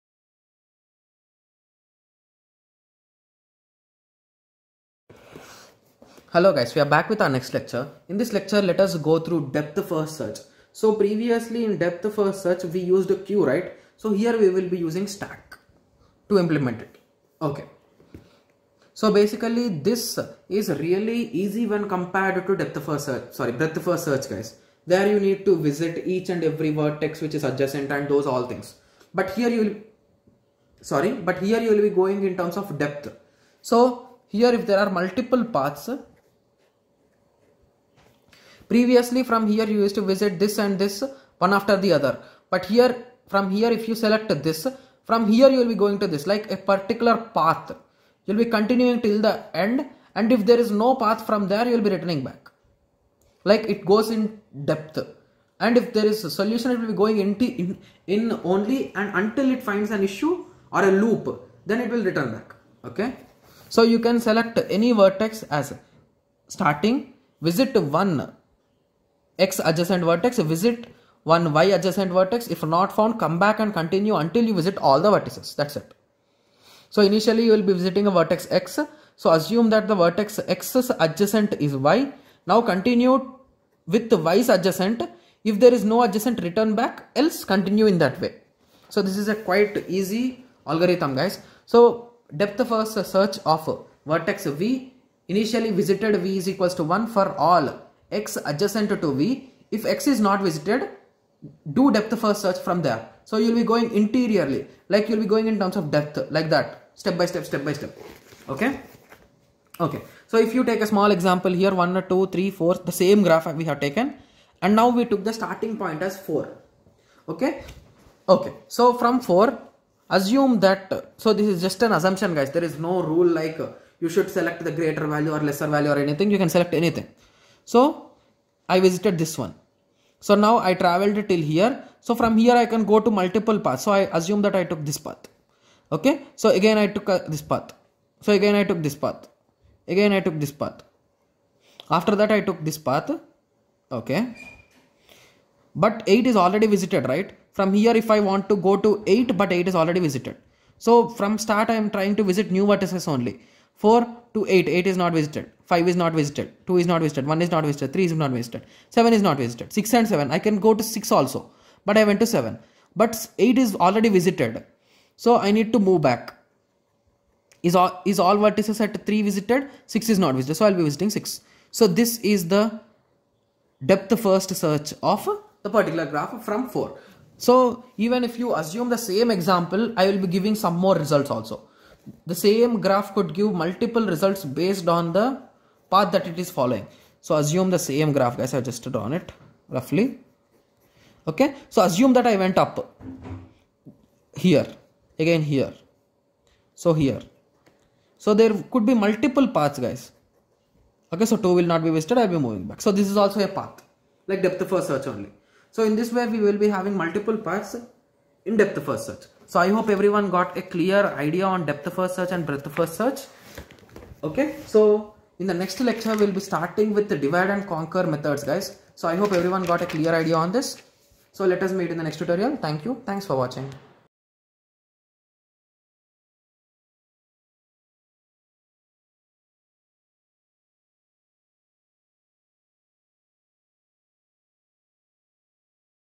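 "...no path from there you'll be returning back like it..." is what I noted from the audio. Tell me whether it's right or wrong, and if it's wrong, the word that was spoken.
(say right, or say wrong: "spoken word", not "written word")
right.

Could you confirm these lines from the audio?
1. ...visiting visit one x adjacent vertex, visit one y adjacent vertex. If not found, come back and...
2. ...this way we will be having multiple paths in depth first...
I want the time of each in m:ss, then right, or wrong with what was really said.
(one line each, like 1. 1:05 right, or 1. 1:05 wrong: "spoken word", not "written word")
1. 1:06 wrong: "starting", not "visiting"
2. 3:26 right.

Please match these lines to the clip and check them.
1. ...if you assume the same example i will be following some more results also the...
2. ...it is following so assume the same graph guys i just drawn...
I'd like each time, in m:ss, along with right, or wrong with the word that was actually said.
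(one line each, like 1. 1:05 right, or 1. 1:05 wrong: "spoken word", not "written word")
1. 2:58 wrong: "giving", not "following"
2. 3:06 right.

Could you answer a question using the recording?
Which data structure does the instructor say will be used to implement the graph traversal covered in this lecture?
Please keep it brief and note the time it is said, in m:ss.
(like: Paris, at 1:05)
Stack, at 0:15.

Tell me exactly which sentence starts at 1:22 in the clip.
Now continue with the y's adjacent.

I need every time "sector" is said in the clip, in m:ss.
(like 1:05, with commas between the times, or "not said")
not said.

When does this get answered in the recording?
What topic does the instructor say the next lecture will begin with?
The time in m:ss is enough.
3:37.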